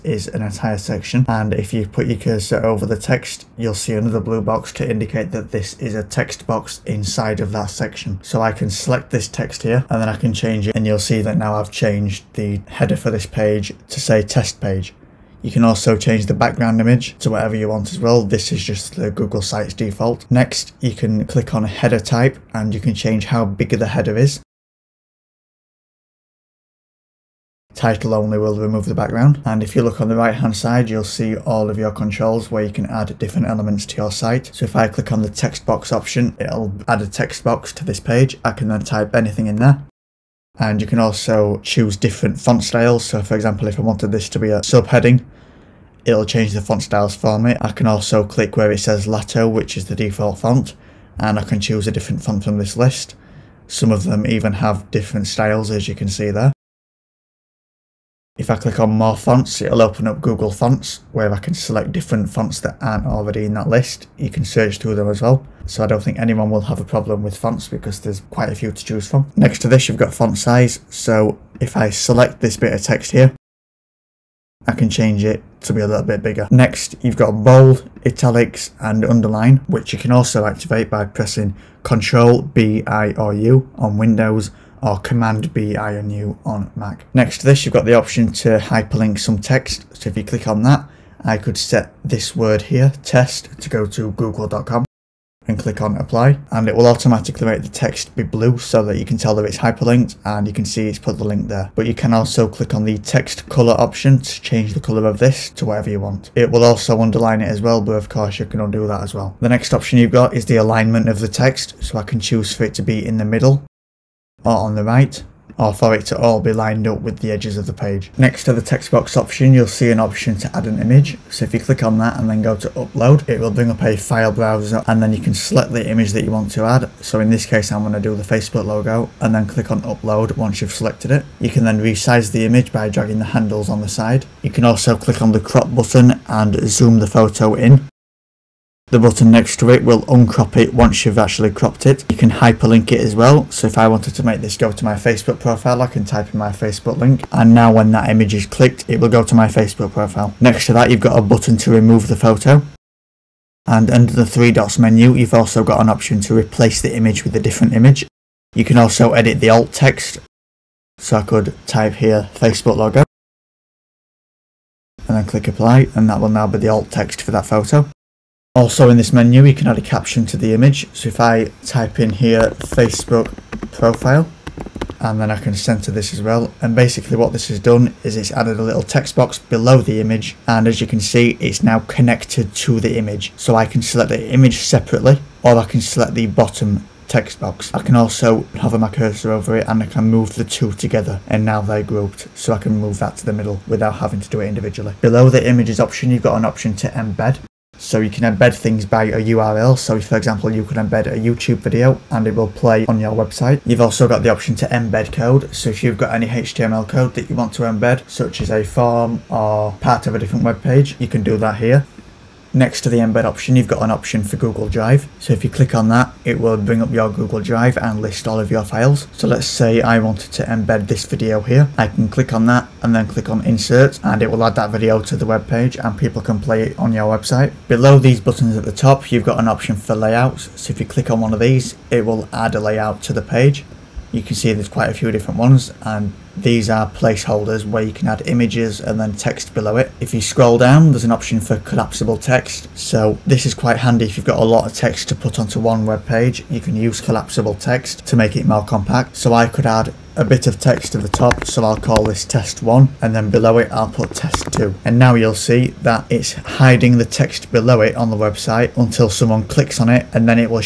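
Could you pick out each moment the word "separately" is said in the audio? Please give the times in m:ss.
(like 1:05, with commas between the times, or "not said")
3:04.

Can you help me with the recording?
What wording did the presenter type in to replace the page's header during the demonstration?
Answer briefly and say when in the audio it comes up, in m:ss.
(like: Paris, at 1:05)
test page, at 0:14.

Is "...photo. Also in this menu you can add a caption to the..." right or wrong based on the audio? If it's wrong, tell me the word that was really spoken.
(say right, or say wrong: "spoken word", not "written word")
right.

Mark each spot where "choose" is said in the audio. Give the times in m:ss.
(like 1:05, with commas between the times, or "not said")
0:41, 0:51, 1:08, 1:52.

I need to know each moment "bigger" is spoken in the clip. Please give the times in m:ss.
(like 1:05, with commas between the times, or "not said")
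1:16.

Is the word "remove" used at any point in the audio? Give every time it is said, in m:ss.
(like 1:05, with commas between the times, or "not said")
0:28, 2:31.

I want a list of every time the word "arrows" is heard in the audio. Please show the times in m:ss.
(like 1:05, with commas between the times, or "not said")
not said.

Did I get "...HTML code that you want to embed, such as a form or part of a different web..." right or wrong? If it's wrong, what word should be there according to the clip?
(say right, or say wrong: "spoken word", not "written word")
right.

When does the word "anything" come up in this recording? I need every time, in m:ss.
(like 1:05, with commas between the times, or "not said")
0:39.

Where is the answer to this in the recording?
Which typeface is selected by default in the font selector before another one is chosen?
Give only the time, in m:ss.
0:49.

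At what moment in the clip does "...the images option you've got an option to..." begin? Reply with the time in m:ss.
3:15.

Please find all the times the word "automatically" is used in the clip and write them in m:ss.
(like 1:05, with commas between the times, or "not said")
1:36.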